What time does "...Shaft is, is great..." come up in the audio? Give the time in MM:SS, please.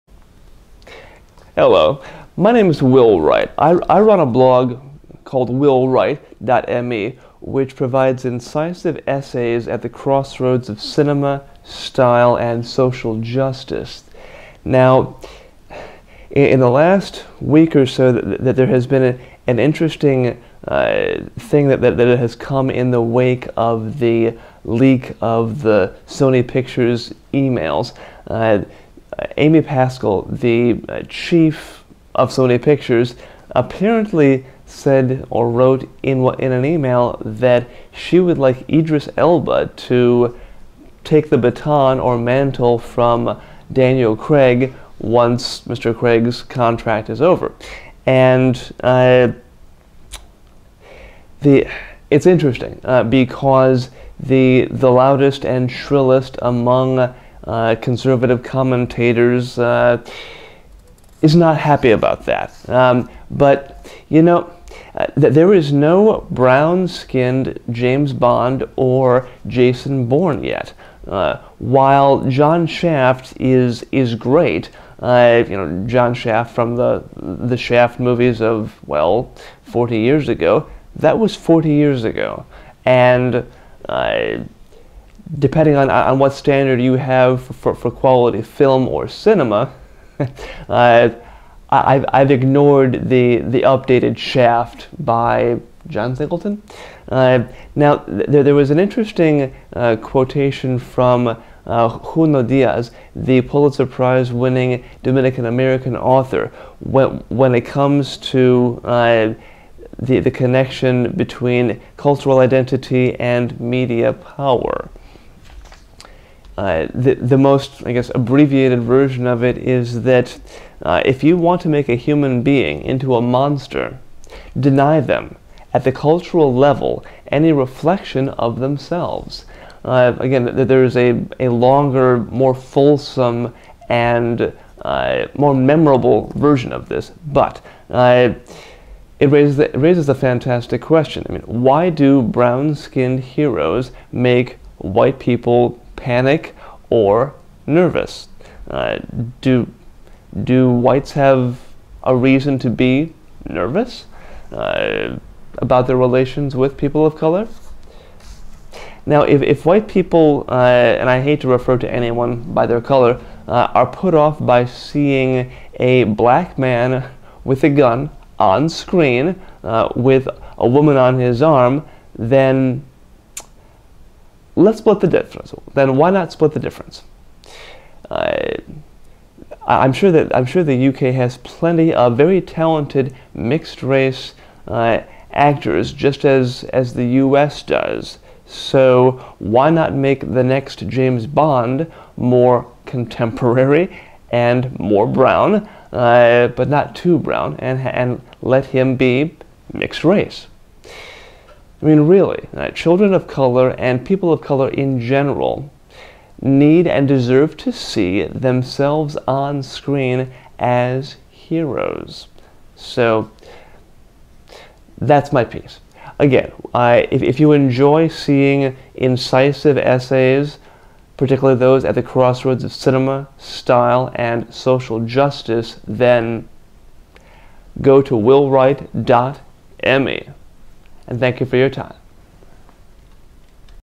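01:12.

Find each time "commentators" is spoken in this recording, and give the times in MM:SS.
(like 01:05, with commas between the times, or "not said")
00:58.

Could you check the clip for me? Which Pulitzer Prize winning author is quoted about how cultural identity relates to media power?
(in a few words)
Junot Díaz.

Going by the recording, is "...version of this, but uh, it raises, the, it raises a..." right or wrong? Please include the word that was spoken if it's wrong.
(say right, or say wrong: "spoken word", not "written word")
right.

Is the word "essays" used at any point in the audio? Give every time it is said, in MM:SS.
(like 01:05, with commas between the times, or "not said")
00:09, 03:39.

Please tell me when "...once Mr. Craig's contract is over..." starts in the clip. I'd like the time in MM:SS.
00:44.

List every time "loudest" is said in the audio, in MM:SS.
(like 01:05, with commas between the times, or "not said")
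00:54.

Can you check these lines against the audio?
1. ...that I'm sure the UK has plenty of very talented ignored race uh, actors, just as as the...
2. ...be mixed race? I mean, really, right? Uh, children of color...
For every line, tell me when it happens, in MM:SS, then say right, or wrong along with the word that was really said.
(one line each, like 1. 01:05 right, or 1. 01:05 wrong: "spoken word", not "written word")
1. 03:00 wrong: "mixed", not "ignored"
2. 03:18 right.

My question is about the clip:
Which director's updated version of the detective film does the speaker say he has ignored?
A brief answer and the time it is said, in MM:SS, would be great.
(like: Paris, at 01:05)
John Singleton, at 01:35.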